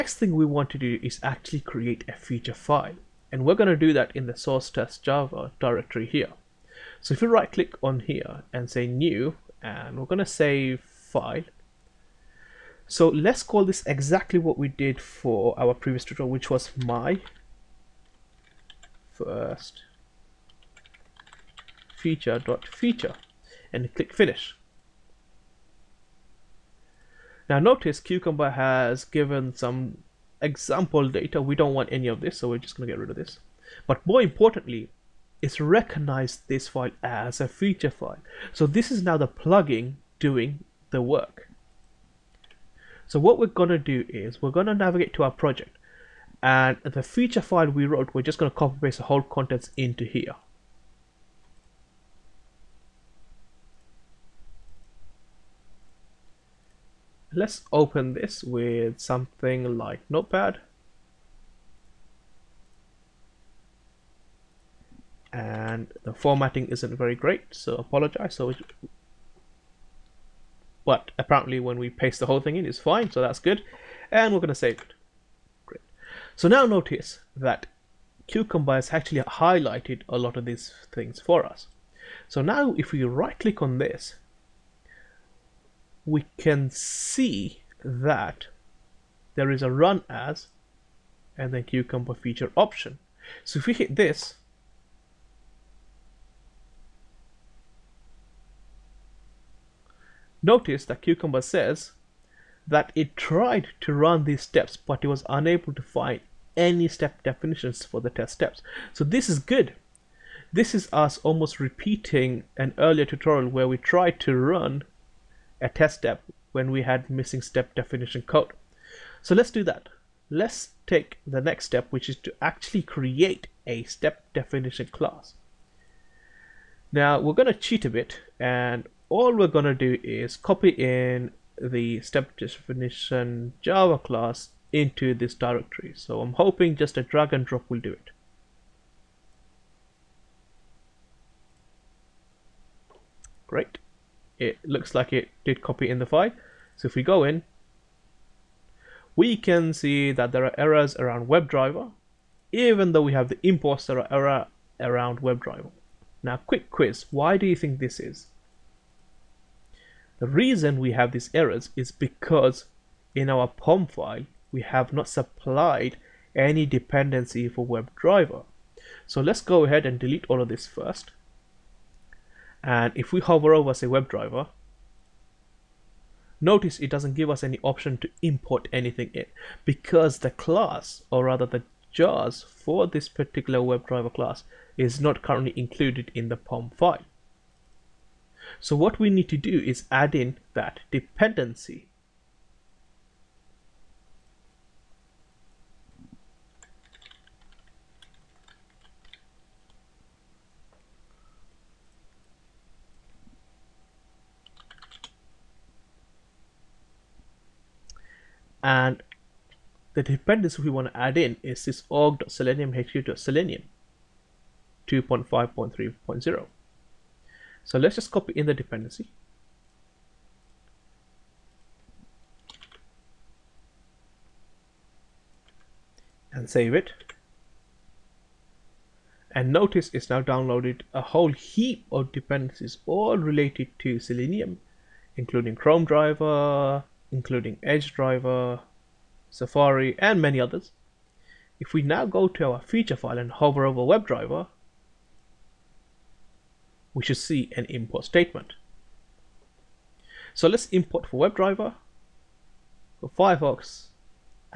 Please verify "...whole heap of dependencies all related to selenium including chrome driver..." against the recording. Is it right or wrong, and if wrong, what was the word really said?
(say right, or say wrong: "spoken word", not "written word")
right.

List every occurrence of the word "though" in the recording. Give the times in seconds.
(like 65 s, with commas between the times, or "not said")
152 s.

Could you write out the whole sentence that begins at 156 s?
Now, quick quiz, why do you think this is?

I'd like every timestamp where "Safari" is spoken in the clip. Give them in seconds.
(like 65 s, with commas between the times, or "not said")
239 s.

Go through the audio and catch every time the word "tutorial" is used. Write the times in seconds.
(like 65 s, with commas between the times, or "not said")
16 s, 113 s.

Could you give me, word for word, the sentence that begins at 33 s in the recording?
But more importantly, it's recognized this file as a feature file.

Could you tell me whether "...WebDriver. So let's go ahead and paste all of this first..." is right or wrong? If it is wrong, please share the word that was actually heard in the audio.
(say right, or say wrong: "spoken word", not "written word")
wrong: "delete", not "paste".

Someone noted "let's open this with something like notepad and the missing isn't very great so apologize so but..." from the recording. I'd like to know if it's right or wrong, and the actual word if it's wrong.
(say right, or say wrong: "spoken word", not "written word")
wrong: "formatting", not "missing".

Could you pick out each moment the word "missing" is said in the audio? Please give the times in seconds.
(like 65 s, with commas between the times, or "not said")
117 s.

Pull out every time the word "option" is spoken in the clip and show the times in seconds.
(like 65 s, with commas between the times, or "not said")
92 s, 177 s.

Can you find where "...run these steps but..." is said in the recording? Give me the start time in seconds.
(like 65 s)
103 s.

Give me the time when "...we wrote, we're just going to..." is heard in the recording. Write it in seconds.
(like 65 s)
47 s.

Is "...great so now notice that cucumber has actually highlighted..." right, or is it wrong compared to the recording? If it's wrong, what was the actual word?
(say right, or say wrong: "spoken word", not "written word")
right.